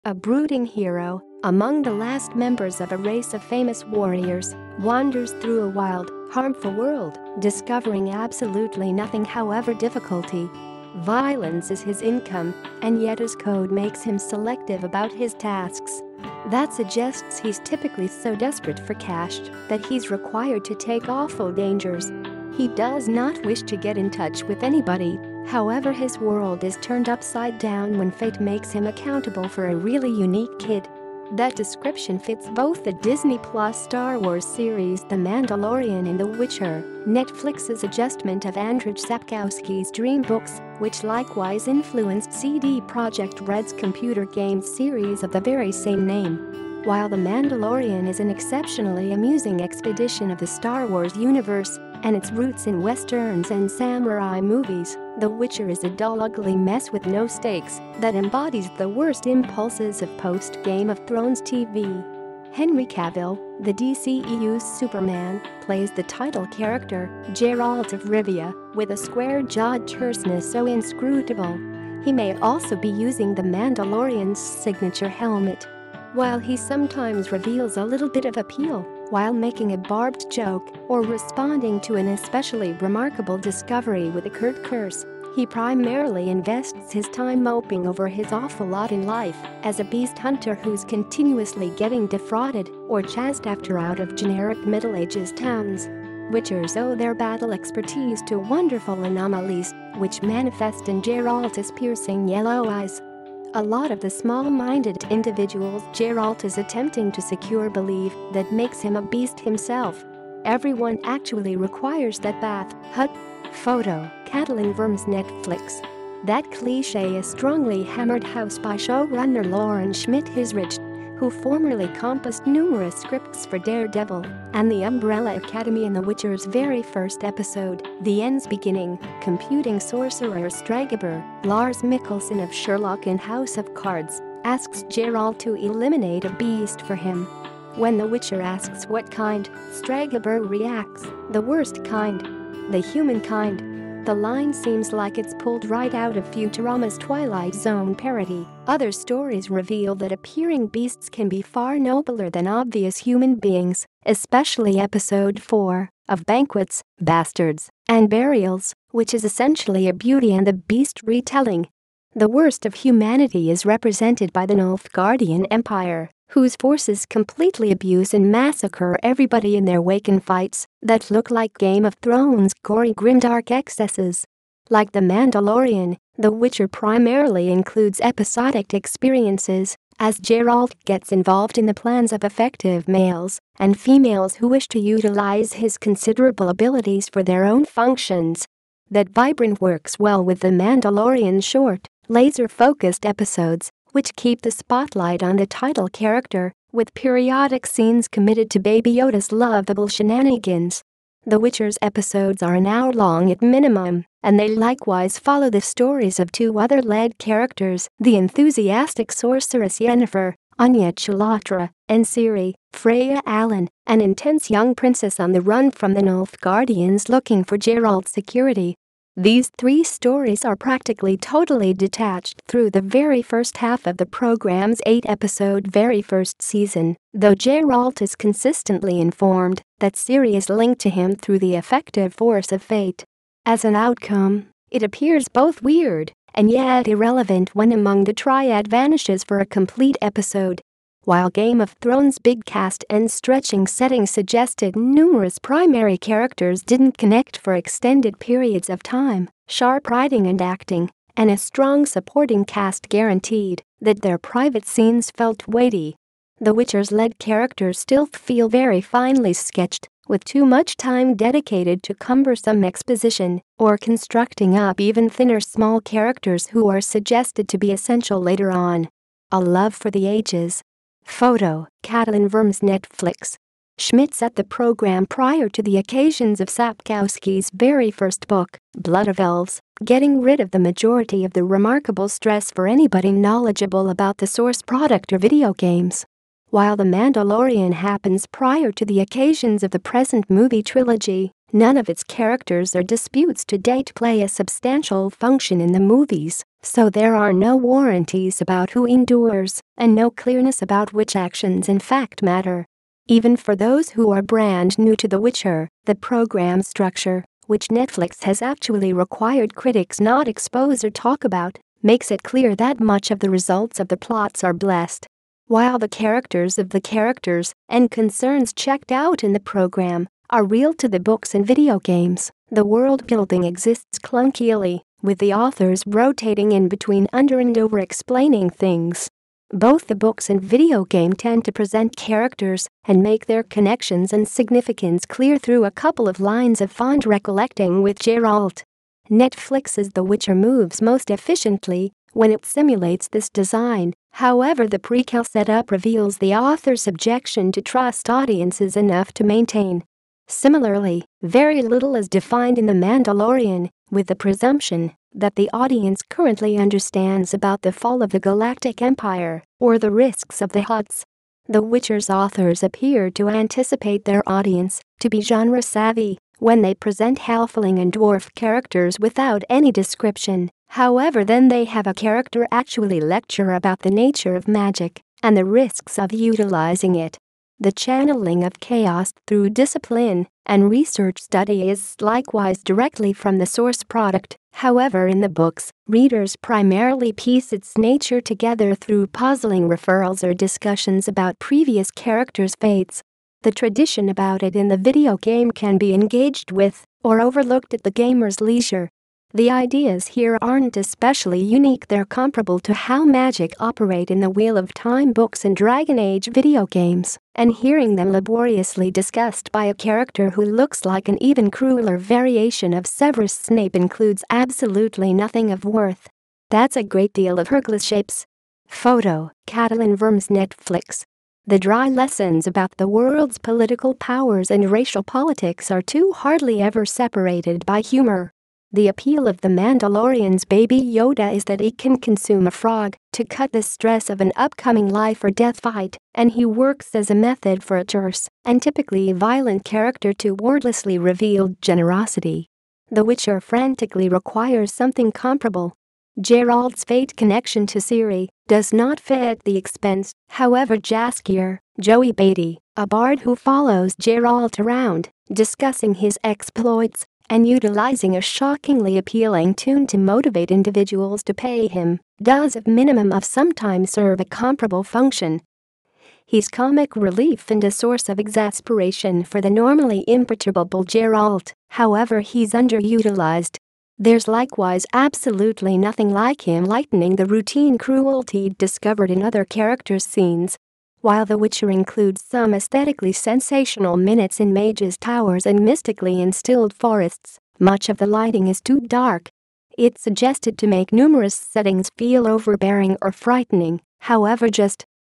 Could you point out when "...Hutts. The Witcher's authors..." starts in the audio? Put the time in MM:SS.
06:00.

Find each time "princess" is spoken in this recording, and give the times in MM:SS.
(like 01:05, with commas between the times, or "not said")
03:34.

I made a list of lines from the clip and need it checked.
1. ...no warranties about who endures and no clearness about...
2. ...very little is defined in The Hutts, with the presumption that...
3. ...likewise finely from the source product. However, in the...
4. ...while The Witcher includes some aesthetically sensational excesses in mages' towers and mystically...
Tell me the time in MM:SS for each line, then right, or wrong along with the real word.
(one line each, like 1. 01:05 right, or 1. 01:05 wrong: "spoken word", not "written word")
1. 04:57 right
2. 05:51 wrong: "Mandalorian", not "Hutts"
3. 06:22 wrong: "directly", not "finely"
4. 08:01 wrong: "minutes", not "excesses".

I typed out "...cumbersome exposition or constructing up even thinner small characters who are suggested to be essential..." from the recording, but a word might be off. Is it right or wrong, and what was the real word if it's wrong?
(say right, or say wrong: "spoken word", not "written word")
right.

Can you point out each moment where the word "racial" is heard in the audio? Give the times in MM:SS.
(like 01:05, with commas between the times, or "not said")
07:04.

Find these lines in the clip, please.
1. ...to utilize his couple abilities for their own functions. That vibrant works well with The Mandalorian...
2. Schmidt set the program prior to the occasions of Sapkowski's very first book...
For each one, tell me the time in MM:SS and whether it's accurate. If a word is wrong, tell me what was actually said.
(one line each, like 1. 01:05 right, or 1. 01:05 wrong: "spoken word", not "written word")
1. 03:04 wrong: "considerable", not "couple"
2. 04:33 right.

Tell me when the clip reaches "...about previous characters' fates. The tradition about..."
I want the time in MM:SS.
06:31.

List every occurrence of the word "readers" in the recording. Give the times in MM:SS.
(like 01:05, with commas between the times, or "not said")
06:25.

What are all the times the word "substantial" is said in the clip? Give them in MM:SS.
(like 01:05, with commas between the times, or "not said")
04:54.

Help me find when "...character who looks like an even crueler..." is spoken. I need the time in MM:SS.
06:49.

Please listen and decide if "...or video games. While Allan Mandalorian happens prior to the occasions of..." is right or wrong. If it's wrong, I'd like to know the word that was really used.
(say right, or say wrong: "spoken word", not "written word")
wrong: "The", not "Allan".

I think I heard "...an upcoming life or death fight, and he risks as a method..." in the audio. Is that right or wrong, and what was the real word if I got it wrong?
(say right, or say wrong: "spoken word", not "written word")
wrong: "works", not "risks".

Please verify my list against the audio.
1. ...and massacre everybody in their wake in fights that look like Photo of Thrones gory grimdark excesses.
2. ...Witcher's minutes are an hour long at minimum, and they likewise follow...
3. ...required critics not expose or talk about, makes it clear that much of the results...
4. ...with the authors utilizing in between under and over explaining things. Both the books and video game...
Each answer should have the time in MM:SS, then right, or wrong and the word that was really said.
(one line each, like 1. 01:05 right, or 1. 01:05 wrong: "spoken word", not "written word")
1. 02:48 wrong: "Game", not "Photo"
2. 03:21 wrong: "episodes", not "minutes"
3. 05:08 right
4. 05:25 wrong: "rotating", not "utilizing".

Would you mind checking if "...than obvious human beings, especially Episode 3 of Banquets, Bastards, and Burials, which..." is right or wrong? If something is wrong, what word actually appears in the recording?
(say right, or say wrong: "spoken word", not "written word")
wrong: "4", not "3".